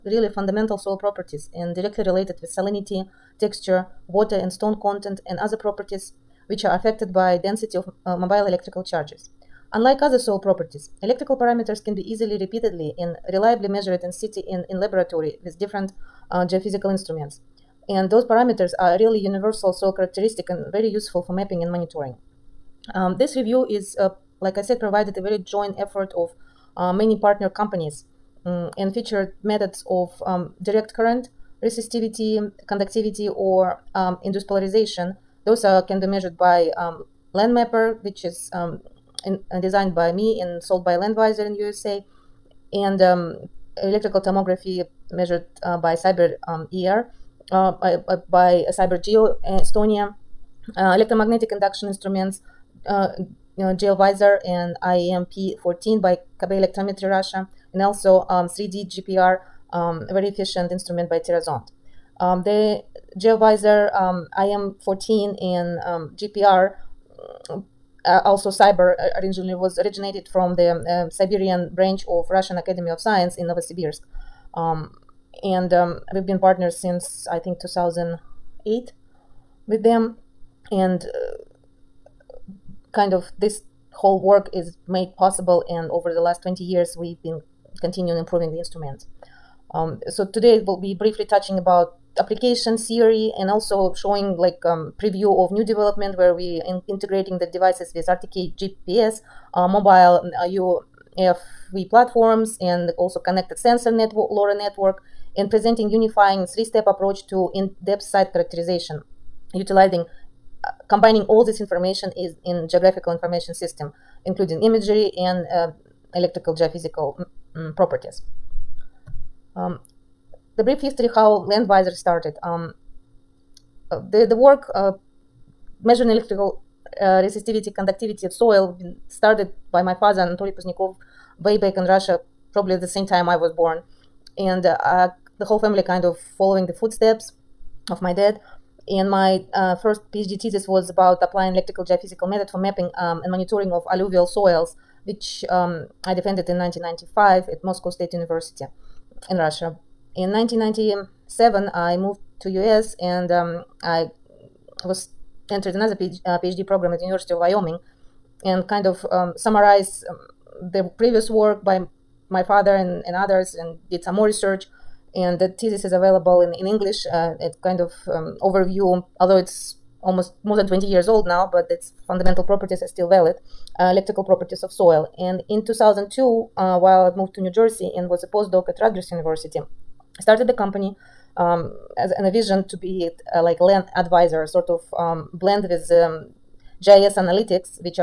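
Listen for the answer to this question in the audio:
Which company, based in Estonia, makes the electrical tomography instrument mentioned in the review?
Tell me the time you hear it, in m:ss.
0:48.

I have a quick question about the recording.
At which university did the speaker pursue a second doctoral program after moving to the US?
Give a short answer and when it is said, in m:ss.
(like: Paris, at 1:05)
University of Wyoming, at 2:37.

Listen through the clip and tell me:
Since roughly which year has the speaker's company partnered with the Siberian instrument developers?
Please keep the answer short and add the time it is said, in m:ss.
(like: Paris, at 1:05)
2008, at 1:17.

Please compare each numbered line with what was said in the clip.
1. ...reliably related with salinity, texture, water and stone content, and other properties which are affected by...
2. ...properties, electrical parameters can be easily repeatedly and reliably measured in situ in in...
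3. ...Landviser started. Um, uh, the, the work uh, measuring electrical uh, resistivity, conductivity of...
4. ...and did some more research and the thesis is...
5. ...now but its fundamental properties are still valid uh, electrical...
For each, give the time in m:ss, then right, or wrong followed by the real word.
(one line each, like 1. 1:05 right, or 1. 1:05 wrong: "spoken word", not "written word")
1. 0:01 wrong: "directly", not "reliably"
2. 0:10 right
3. 2:01 right
4. 2:43 right
5. 2:51 right.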